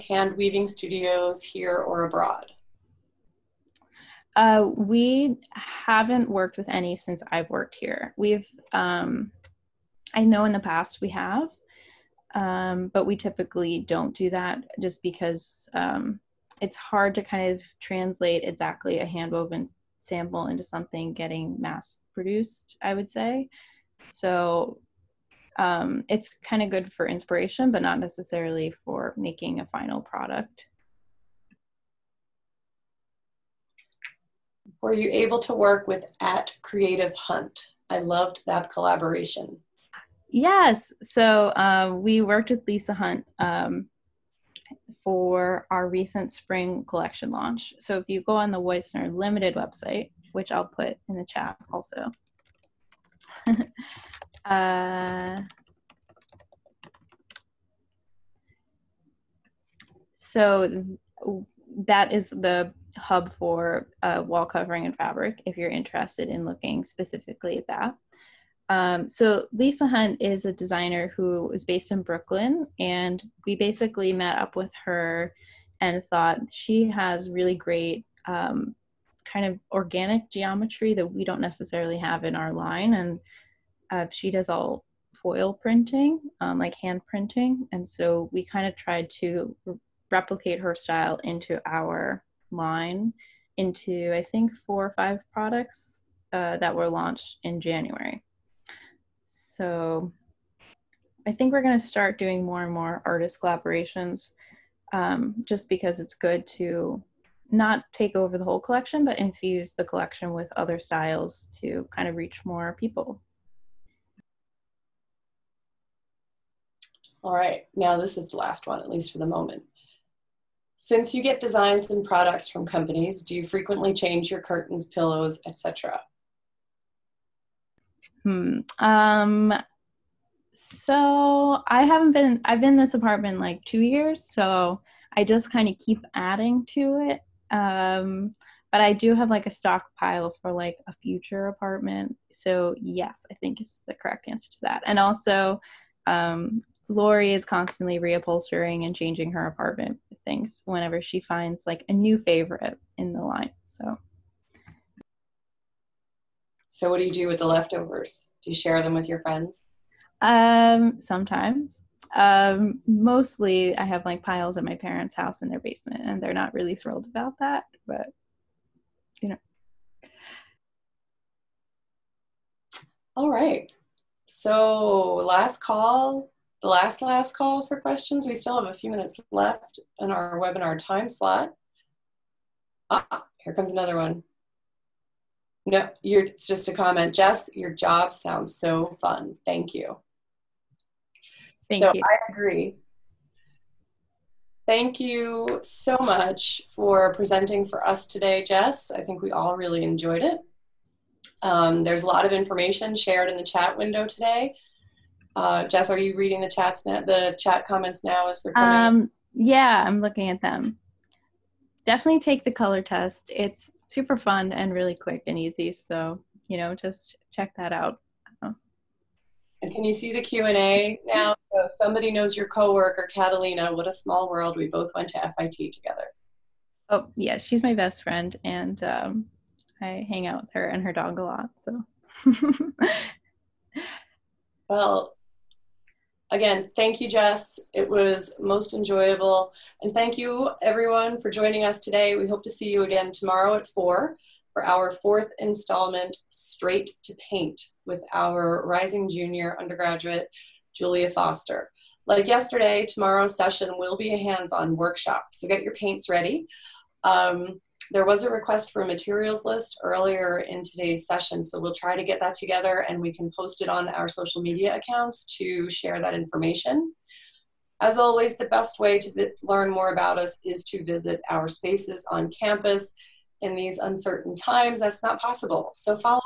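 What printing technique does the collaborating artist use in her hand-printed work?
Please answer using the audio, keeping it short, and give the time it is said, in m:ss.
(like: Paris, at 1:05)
foil printing, at 1:25.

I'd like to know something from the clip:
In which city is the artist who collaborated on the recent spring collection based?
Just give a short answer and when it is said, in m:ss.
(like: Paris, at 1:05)
Brooklyn, at 1:11.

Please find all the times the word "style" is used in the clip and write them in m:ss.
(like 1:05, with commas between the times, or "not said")
1:30, 1:50.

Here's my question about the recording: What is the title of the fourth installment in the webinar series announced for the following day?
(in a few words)
Straight to Paint.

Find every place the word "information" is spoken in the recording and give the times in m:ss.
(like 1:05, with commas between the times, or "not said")
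3:22, 4:26.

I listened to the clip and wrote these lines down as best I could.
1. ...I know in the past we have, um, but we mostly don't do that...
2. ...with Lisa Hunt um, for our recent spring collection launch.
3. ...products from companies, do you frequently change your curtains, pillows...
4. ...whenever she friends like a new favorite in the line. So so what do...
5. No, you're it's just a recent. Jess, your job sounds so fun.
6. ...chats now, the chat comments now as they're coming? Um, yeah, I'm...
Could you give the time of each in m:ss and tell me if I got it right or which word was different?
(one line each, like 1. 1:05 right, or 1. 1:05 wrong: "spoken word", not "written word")
1. 0:10 wrong: "typically", not "mostly"
2. 0:42 right
3. 2:02 right
4. 2:30 wrong: "finds", not "friends"
5. 3:05 wrong: "comment", not "recent"
6. 3:26 right.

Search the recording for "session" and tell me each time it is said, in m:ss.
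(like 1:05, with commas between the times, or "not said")
4:13, 4:21.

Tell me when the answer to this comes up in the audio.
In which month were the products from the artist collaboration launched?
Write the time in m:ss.
1:37.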